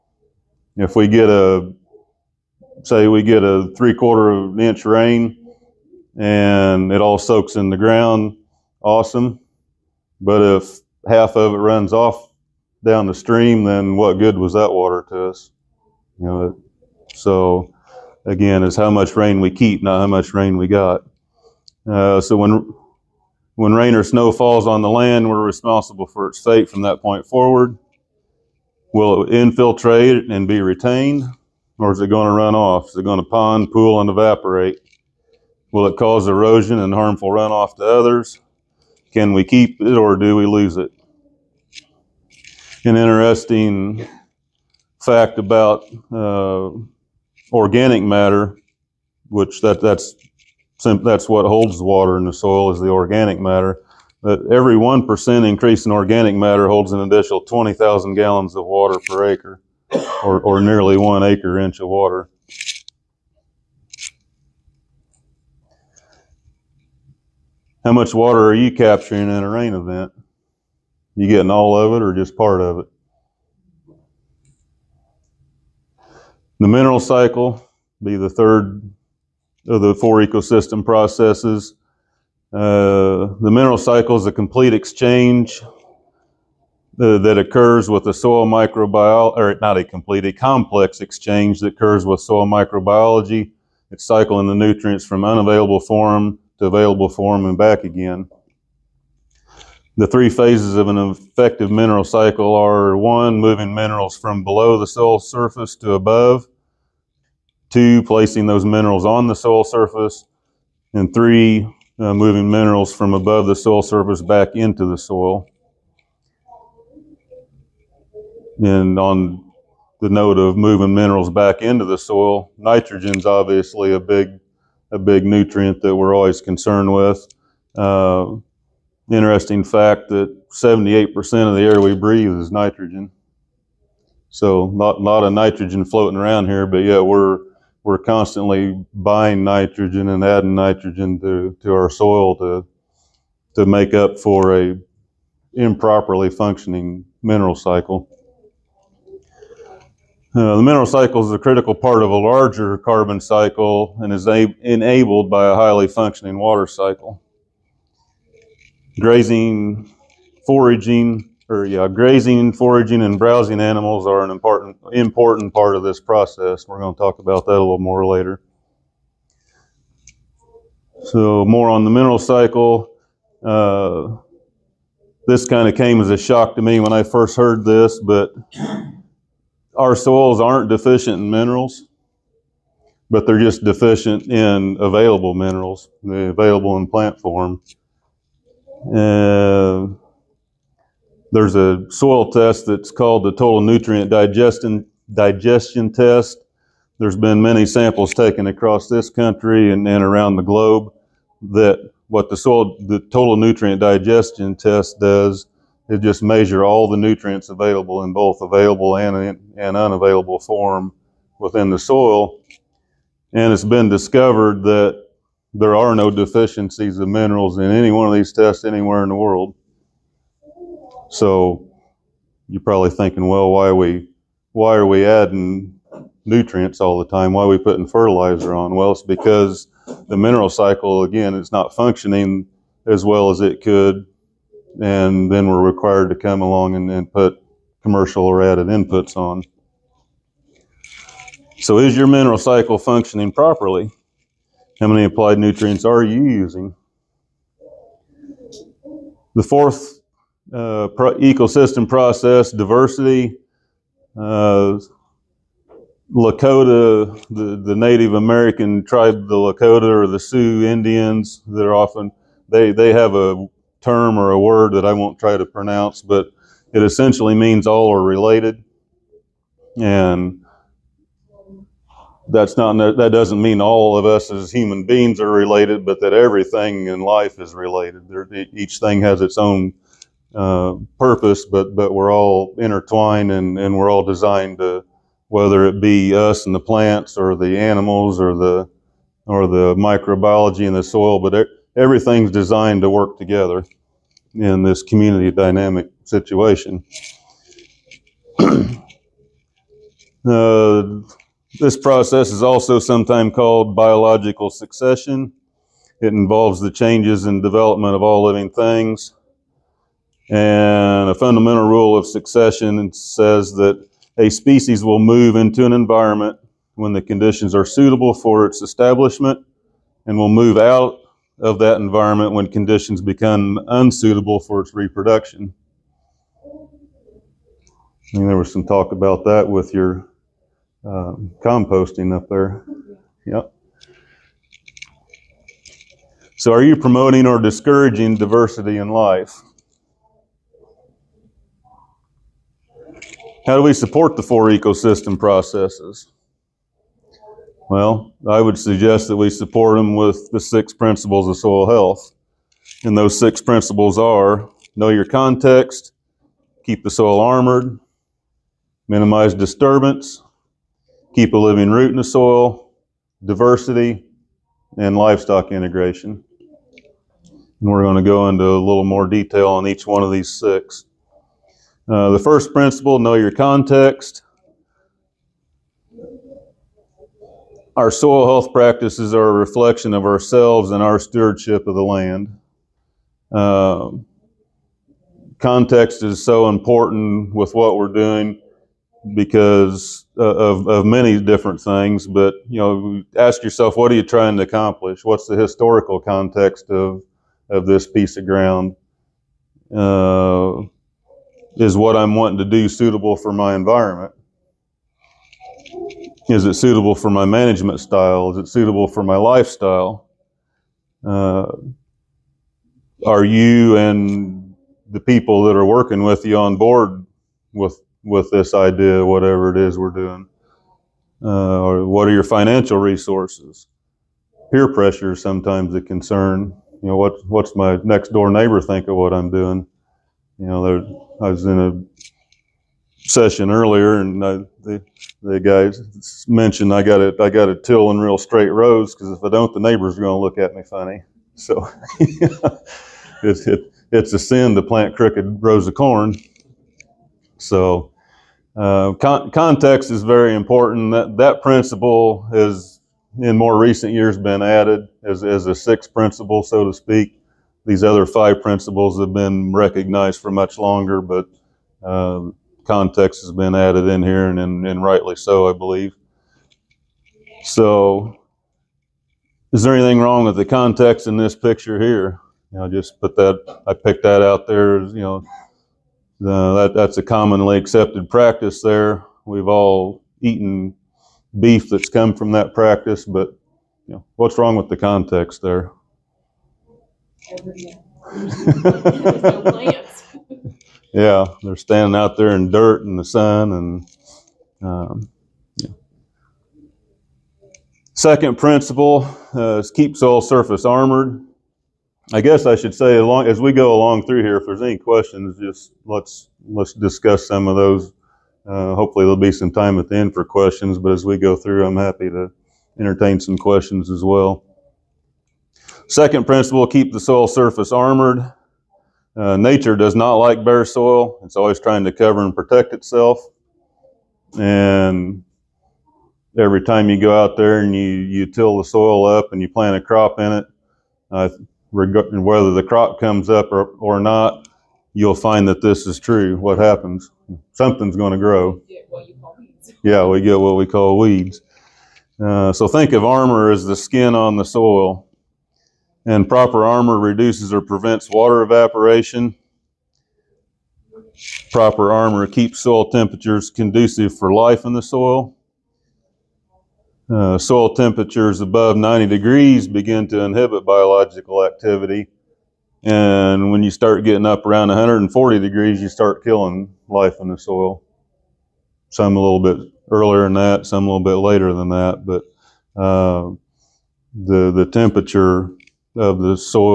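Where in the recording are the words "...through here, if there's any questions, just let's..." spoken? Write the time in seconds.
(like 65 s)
504 s.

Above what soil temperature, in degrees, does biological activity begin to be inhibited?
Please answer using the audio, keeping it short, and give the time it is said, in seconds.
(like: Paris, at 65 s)
90 degrees, at 558 s.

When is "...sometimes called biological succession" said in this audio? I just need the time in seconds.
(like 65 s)
302 s.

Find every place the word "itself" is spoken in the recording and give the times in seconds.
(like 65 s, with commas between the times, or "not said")
522 s.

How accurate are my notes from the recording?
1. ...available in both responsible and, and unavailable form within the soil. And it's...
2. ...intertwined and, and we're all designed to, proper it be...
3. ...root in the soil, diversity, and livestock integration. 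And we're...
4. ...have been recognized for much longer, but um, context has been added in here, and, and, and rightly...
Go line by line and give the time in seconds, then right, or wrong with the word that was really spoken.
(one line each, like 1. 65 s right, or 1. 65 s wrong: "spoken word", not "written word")
1. 207 s wrong: "available", not "responsible"
2. 282 s wrong: "whether", not "proper"
3. 361 s right
4. 458 s right.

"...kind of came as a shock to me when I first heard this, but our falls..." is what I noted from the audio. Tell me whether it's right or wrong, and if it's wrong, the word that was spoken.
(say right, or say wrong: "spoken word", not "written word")
wrong: "soils", not "falls".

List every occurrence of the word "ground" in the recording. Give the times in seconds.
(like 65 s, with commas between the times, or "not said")
7 s, 398 s.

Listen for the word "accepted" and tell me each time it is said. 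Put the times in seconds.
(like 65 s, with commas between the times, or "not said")
477 s.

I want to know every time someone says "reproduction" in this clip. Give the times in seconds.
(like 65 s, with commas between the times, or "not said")
324 s.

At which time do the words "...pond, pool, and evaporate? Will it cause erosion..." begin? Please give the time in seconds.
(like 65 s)
33 s.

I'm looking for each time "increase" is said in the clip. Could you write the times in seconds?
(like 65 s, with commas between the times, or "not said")
55 s.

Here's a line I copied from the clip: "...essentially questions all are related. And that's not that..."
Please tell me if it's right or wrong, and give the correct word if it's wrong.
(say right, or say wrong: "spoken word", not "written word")
wrong: "means", not "questions".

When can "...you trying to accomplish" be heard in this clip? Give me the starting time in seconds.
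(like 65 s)
393 s.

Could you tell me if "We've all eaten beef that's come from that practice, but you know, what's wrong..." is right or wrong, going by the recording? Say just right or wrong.
right.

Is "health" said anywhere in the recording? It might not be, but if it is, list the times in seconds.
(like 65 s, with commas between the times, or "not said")
351 s, 378 s.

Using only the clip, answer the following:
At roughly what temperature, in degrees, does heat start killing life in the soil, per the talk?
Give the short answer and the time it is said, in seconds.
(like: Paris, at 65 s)
140 degrees, at 564 s.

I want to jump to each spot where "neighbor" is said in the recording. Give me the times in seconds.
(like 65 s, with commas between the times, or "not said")
428 s, 439 s.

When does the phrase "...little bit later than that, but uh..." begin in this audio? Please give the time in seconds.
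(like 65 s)
570 s.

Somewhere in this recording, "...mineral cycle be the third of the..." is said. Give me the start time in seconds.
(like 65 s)
76 s.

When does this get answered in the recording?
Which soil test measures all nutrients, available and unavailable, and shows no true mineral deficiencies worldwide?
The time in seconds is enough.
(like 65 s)
202 s.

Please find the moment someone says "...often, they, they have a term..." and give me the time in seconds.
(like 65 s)
261 s.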